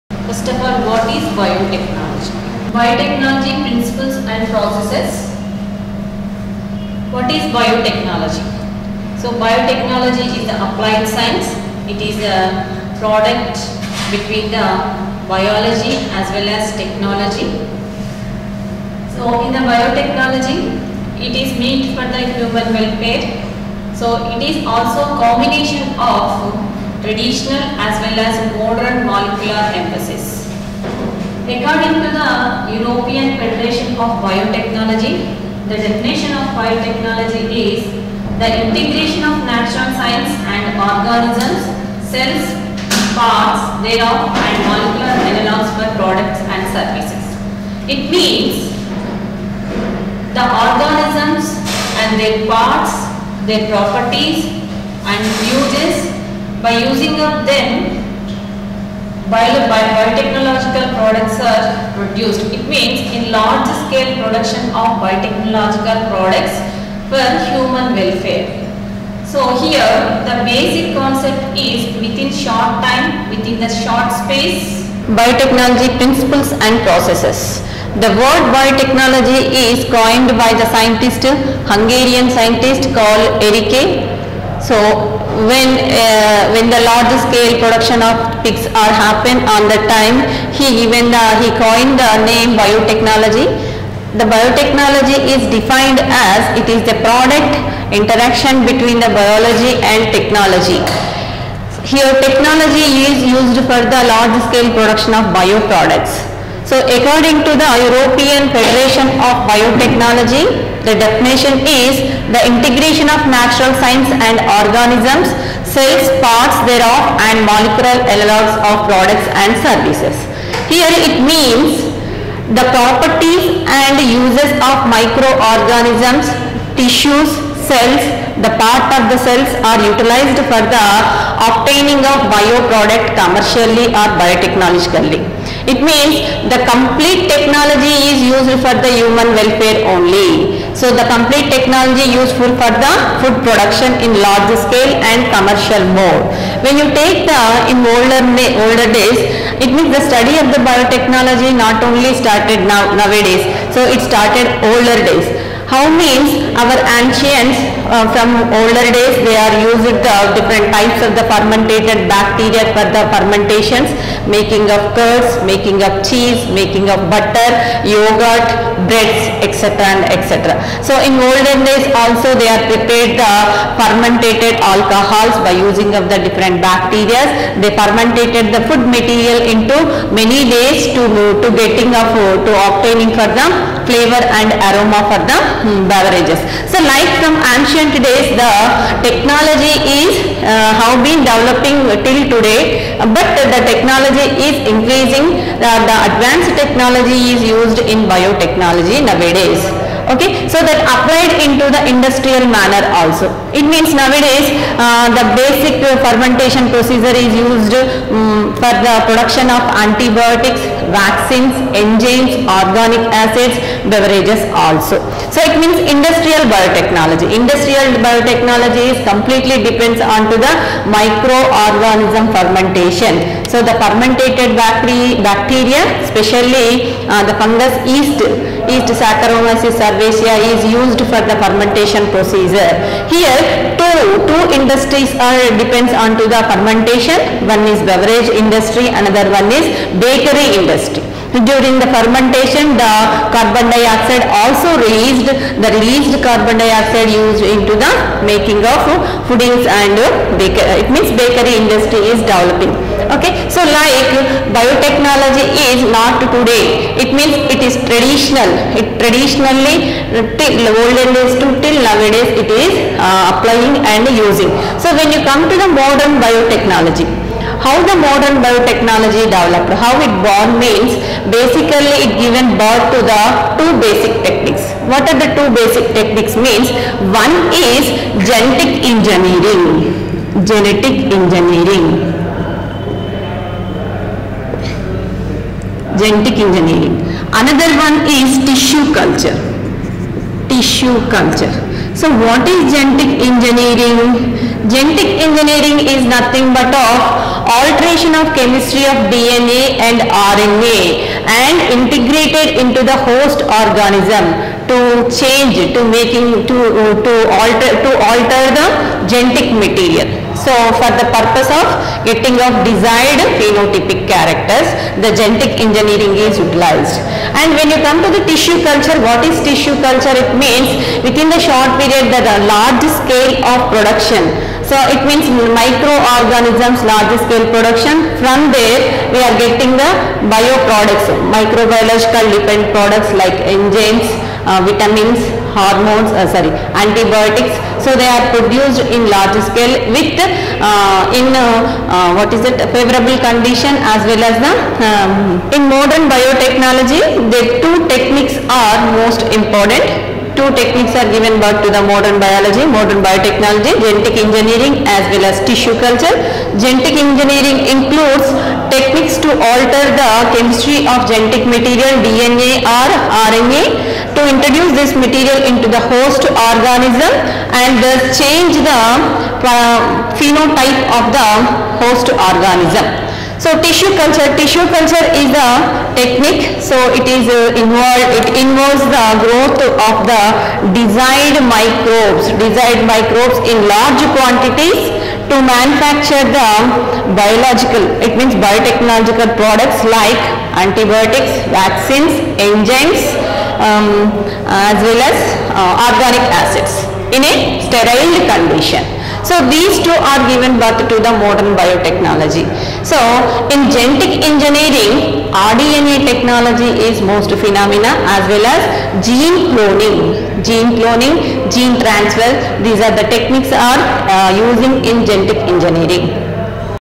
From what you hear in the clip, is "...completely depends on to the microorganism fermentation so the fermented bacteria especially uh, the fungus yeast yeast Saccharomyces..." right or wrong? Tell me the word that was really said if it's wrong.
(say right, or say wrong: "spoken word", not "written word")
right.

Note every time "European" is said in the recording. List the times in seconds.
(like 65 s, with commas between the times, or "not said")
32 s, 107 s.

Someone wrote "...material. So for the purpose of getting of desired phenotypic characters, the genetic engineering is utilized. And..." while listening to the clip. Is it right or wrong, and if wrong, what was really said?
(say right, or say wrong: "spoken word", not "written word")
right.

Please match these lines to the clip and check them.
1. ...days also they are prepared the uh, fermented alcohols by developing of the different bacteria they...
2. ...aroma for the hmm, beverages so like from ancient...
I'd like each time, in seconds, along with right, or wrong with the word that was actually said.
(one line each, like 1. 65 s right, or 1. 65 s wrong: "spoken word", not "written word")
1. 171 s wrong: "using", not "developing"
2. 184 s right.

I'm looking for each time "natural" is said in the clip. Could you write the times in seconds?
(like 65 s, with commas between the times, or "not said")
39 s, 113 s.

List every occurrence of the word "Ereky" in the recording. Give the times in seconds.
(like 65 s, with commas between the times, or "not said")
83 s.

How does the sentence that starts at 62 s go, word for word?
It means in large scale production of biotechnological products for human welfare.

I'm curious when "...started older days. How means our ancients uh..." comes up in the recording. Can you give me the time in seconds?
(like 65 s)
154 s.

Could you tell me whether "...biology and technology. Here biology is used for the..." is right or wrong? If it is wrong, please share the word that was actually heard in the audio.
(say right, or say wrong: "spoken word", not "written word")
wrong: "technology", not "biology".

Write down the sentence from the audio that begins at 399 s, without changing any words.
So these two are given birth to the modern biotechnology.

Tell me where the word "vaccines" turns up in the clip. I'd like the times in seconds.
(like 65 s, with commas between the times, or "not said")
210 s, 391 s.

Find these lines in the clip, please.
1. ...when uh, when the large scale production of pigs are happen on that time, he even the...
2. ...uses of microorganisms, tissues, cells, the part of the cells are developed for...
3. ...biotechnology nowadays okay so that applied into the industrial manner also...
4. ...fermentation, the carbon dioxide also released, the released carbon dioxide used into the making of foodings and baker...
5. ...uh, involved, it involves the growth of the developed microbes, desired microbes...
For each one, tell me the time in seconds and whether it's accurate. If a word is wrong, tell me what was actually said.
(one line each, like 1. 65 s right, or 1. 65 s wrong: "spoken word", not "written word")
1. 85 s right
2. 124 s wrong: "utilized", not "developed"
3. 198 s right
4. 241 s right
5. 377 s wrong: "desired", not "developed".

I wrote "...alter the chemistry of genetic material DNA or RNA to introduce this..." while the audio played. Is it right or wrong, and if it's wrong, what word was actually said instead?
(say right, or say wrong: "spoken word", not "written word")
right.